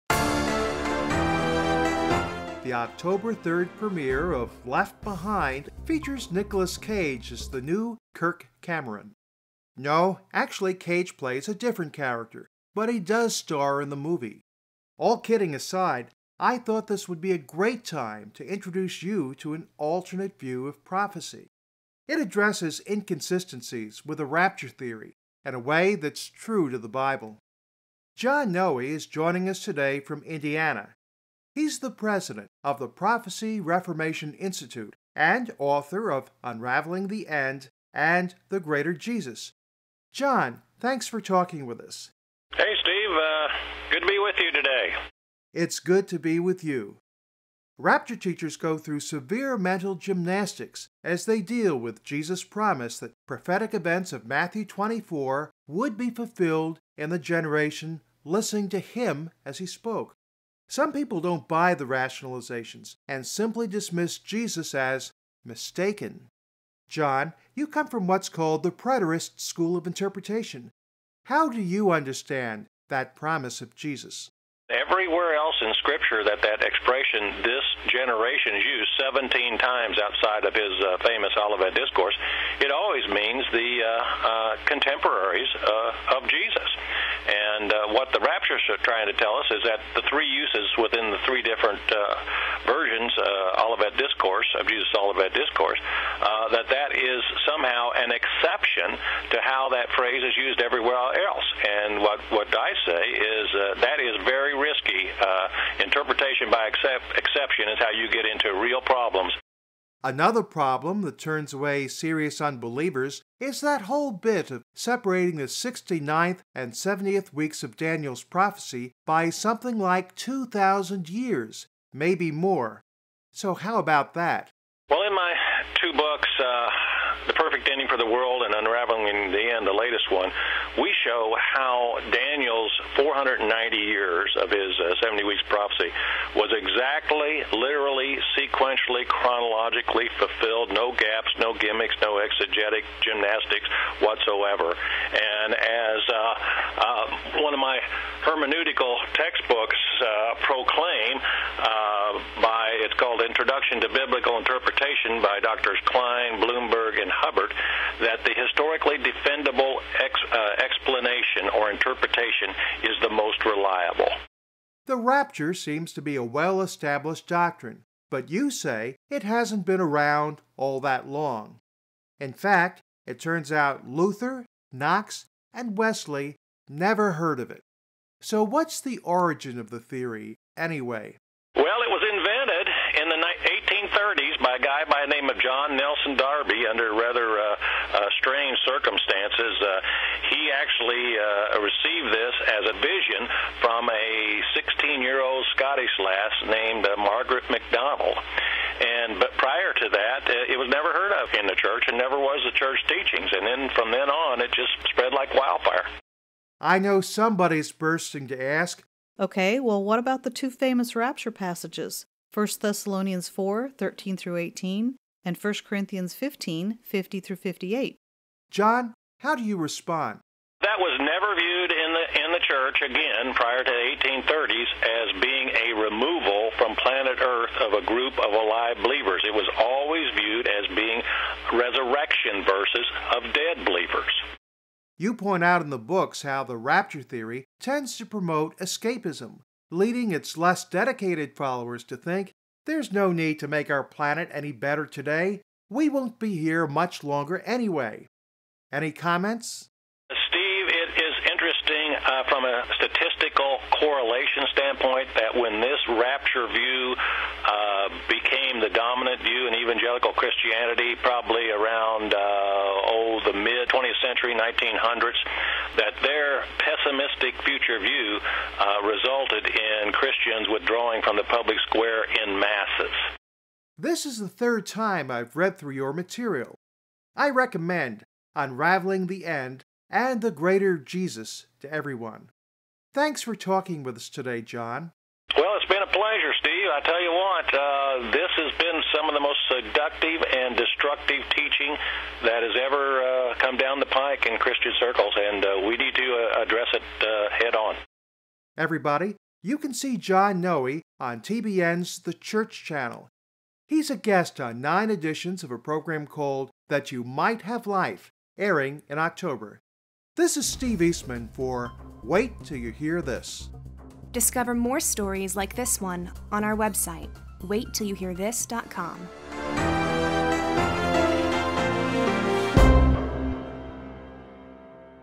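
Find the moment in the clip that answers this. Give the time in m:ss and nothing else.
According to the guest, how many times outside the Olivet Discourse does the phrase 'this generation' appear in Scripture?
1:19.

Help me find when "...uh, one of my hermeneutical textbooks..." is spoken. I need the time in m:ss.
2:26.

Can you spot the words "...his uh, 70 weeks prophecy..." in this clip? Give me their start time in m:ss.
2:14.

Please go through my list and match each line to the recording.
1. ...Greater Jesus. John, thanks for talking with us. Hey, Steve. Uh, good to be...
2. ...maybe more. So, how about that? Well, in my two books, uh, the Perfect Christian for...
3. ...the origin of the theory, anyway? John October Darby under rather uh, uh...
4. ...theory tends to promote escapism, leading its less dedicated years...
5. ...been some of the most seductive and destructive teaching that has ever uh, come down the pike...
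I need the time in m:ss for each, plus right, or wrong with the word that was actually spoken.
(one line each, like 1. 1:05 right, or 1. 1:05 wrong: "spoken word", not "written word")
1. 0:38 right
2. 2:01 wrong: "Ending", not "Christian"
3. 2:58 wrong: "Nelson", not "October"
4. 3:57 wrong: "followers", not "years"
5. 4:48 right.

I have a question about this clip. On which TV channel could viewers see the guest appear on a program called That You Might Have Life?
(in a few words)
The Church Channel.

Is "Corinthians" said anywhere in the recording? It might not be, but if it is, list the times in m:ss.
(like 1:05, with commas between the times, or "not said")
3:35.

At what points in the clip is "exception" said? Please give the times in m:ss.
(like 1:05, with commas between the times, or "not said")
1:38, 1:46.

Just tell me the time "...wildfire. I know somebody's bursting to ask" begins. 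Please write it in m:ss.
3:25.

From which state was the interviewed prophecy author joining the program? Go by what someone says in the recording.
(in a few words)
Indiana.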